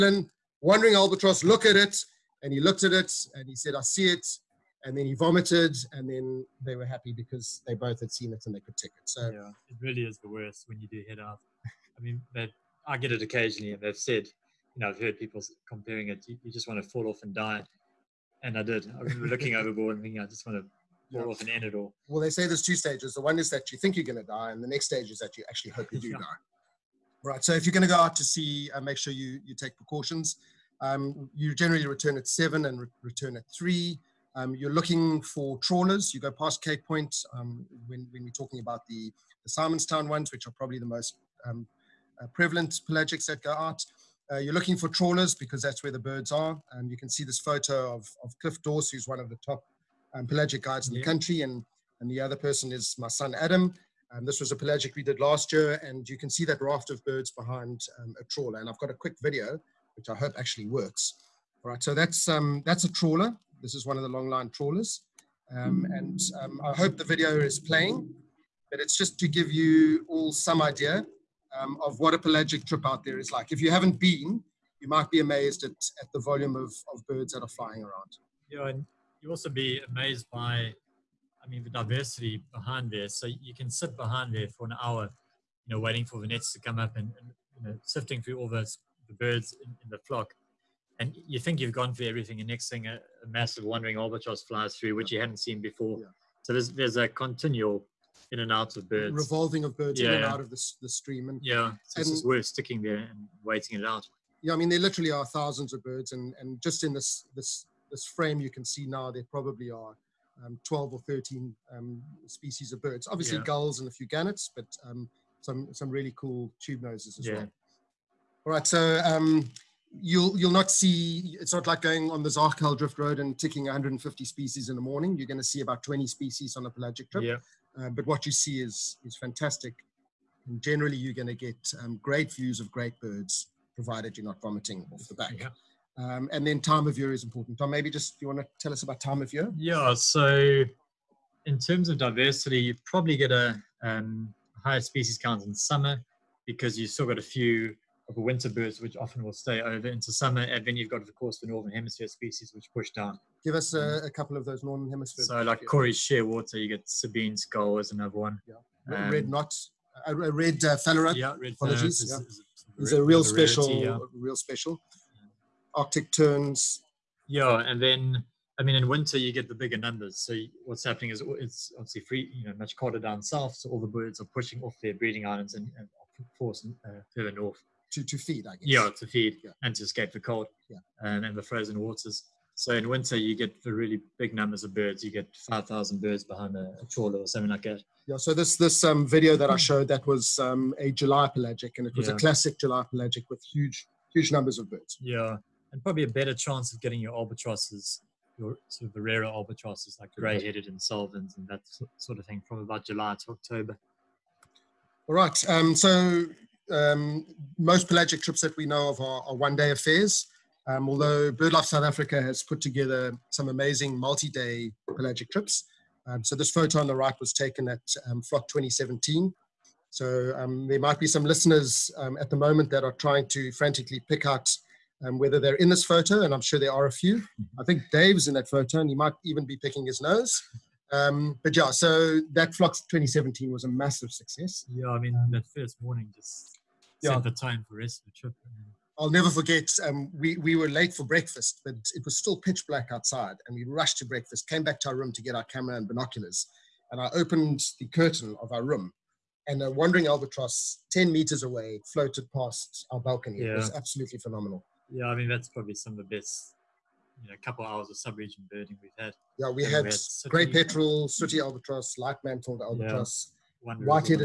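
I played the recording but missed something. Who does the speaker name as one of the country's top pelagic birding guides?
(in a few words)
Cliff Dorse.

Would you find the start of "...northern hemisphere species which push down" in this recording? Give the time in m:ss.
2:31.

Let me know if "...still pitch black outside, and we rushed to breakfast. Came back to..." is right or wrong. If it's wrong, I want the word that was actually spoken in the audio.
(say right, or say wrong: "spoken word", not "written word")
right.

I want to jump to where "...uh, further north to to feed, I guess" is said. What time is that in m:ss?
2:56.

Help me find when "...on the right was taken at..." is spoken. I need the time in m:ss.
3:36.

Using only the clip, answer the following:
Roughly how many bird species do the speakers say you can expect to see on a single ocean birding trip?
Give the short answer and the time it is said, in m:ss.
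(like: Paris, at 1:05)
20, at 2:05.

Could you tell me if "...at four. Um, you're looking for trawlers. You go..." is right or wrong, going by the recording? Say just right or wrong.
wrong.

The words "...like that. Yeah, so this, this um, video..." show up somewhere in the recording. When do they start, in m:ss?
3:07.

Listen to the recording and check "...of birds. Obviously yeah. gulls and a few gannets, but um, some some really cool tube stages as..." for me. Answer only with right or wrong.
wrong.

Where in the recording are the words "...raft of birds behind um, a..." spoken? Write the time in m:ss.
0:56.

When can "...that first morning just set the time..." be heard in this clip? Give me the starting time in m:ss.
3:55.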